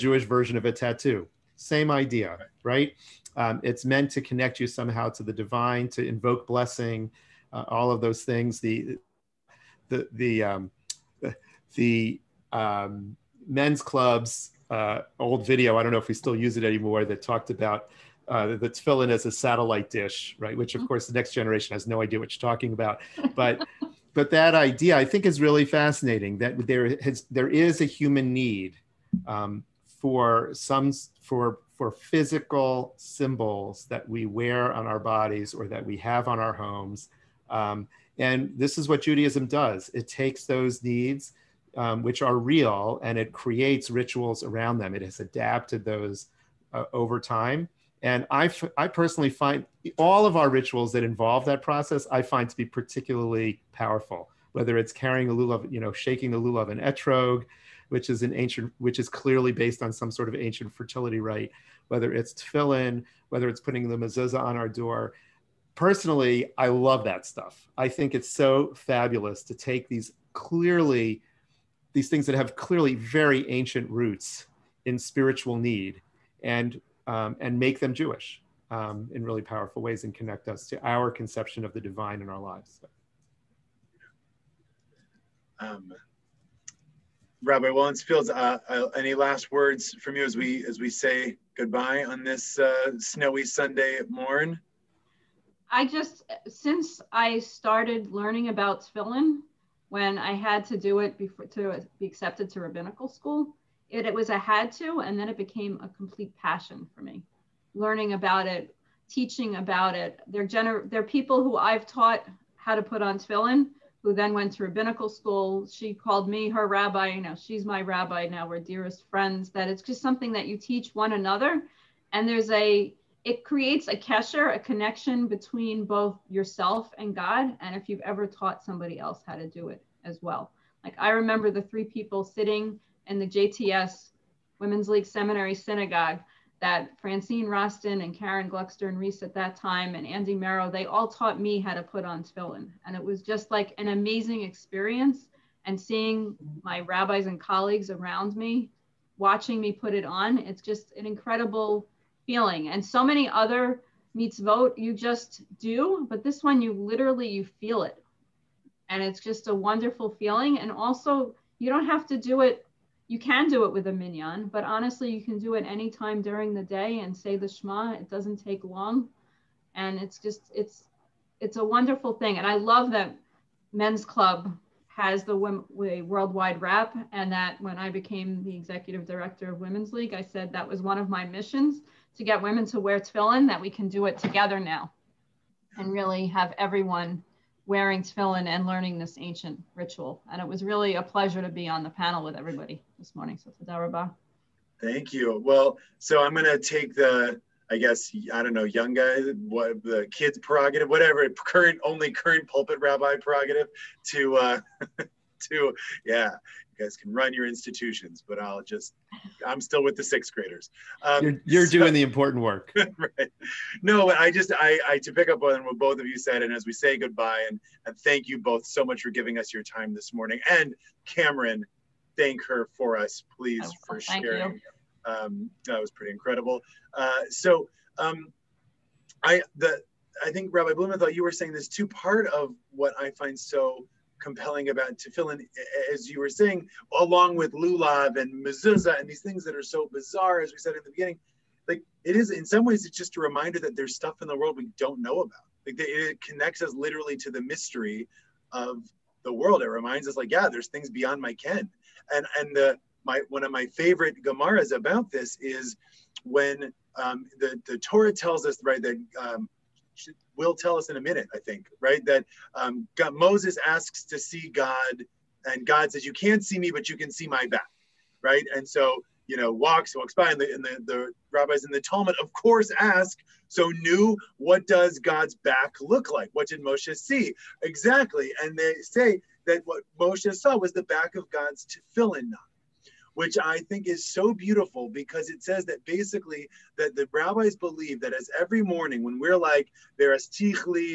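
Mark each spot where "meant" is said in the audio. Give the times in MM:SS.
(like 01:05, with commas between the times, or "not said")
00:03.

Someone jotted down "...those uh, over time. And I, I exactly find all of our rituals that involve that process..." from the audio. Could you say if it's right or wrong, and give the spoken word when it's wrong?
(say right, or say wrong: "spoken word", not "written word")
wrong: "personally", not "exactly".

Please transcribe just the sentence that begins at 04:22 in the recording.
That um, God, Moses asks to see God, and God says, "You can't see me, but you can see my back," right?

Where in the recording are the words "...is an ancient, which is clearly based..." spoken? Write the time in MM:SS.
00:58.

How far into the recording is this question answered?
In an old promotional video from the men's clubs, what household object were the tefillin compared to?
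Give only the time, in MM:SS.
00:19.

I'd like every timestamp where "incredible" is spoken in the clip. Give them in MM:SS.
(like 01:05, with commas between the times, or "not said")
02:31, 03:46.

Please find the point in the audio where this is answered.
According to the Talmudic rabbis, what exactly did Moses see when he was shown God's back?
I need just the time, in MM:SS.
04:40.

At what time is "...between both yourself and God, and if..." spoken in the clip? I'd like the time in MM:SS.
02:05.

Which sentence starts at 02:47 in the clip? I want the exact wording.
It doesn't take long, and it's just it's it's a wonderful thing.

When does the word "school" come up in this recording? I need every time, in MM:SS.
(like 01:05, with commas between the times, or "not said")
01:43, 01:55.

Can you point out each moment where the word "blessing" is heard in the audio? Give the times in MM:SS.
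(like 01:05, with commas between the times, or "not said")
00:06.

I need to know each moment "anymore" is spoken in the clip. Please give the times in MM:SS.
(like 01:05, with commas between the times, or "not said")
00:16.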